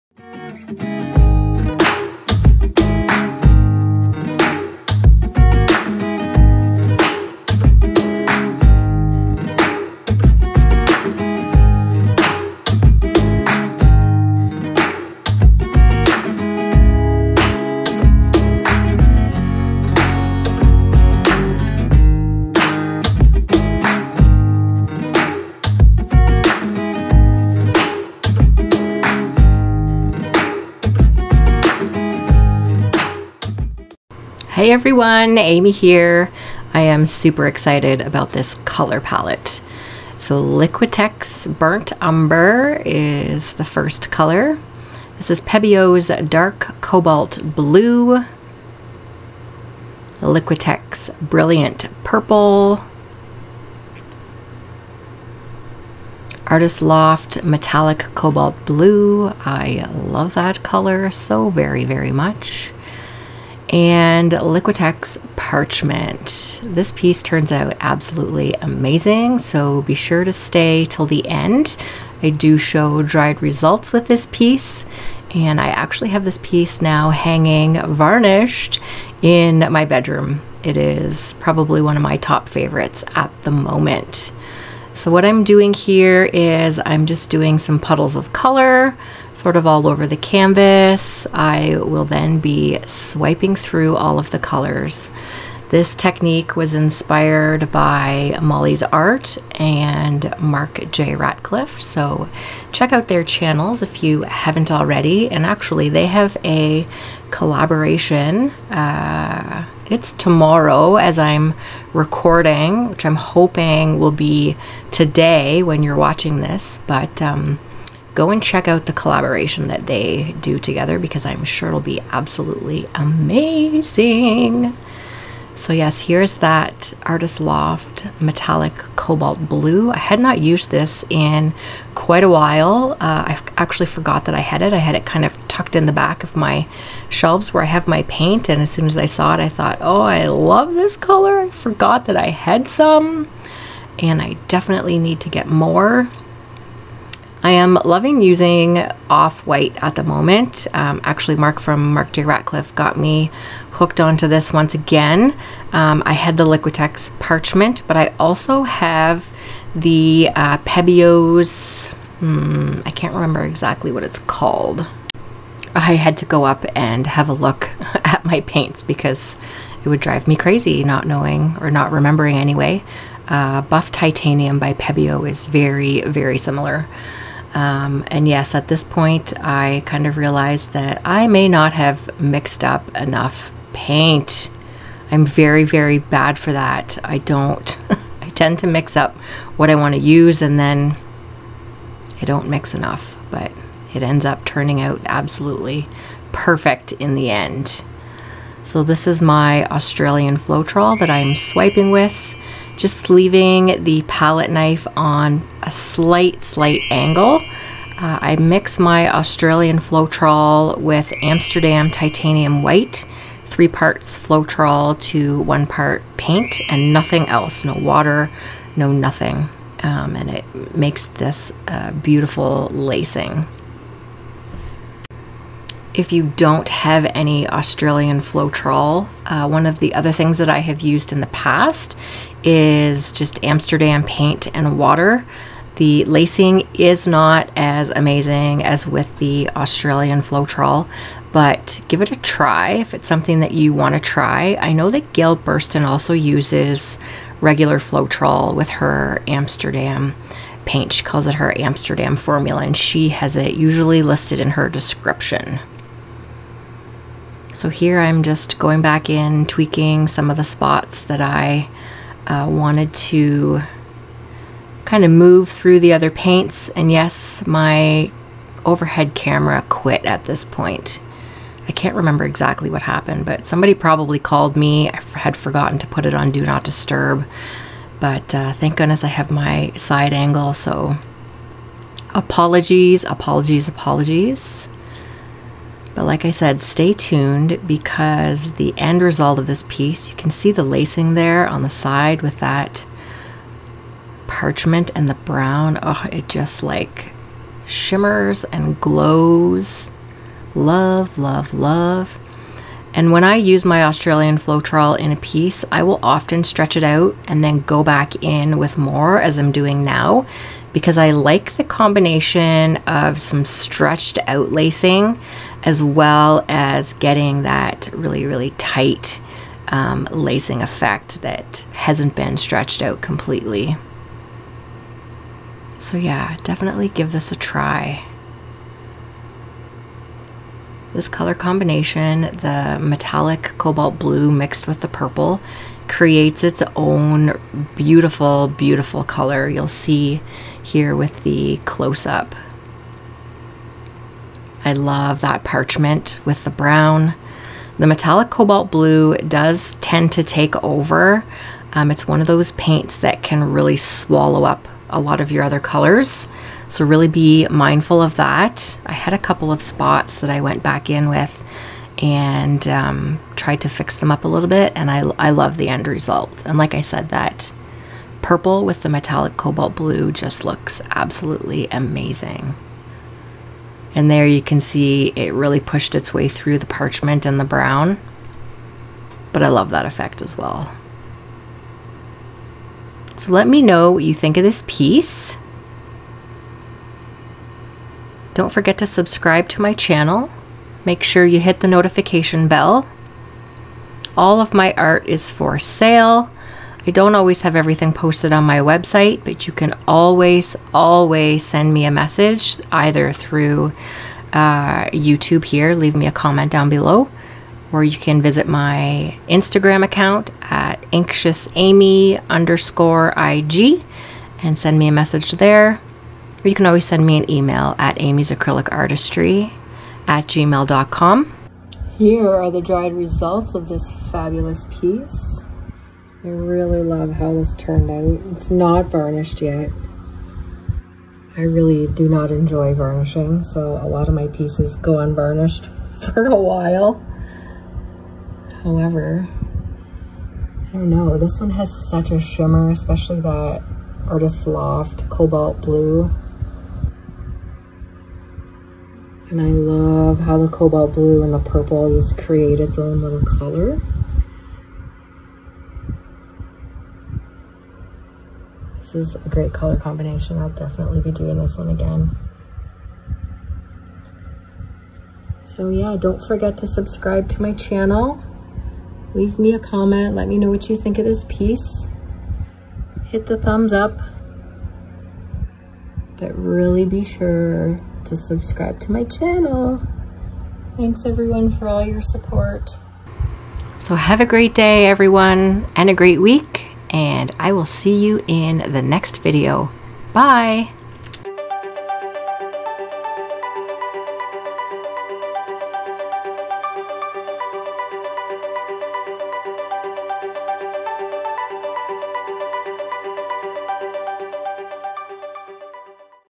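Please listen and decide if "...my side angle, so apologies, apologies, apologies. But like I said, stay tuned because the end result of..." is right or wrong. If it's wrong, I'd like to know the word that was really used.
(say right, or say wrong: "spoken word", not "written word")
right.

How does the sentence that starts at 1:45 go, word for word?
And actually, they have a collaboration.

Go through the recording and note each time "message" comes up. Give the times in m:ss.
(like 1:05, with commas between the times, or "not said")
6:41, 6:54.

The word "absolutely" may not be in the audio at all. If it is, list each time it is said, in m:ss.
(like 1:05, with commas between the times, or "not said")
1:07, 2:02, 3:15, 6:10.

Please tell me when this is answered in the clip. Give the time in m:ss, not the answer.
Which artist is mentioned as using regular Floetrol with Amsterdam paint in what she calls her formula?
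4:05.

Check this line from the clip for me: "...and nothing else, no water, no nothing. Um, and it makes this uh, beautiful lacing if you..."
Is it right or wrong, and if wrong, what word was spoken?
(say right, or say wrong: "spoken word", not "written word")
right.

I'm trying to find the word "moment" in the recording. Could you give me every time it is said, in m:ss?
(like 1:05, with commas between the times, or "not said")
1:23, 2:30.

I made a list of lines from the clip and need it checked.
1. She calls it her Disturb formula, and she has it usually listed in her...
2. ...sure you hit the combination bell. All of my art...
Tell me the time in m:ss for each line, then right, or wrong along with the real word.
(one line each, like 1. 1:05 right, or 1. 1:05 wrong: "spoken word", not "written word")
1. 4:10 wrong: "Amsterdam", not "Disturb"
2. 6:31 wrong: "notification", not "combination".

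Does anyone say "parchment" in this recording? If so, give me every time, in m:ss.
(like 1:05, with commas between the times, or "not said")
1:05, 2:37, 4:54, 5:45, 6:16.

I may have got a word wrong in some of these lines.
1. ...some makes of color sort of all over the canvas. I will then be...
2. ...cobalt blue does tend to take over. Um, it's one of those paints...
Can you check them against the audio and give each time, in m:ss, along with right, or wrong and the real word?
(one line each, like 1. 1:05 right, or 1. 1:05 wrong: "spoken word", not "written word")
1. 1:27 wrong: "puddles", not "makes"
2. 5:48 right.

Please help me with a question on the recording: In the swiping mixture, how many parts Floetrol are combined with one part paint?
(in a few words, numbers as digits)
3.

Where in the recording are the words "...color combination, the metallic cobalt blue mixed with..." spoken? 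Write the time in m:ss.
5:31.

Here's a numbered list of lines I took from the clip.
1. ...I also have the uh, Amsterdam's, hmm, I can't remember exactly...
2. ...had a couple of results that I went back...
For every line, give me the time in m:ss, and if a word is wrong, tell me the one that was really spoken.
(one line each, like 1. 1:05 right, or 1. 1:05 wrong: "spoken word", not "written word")
1. 2:37 wrong: "Pebeo", not "Amsterdam"
2. 5:58 wrong: "spots", not "results".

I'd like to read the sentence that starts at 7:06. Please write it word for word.
I really love how this turned out.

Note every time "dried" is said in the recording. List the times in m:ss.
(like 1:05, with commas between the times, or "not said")
1:13, 7:02.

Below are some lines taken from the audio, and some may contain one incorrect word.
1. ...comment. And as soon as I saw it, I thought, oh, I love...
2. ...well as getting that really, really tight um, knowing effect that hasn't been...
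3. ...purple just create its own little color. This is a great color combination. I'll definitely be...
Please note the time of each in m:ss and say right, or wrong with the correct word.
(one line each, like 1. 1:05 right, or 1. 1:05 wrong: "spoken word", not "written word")
1. 2:18 wrong: "paint", not "comment"
2. 5:15 wrong: "lacing", not "knowing"
3. 7:31 right.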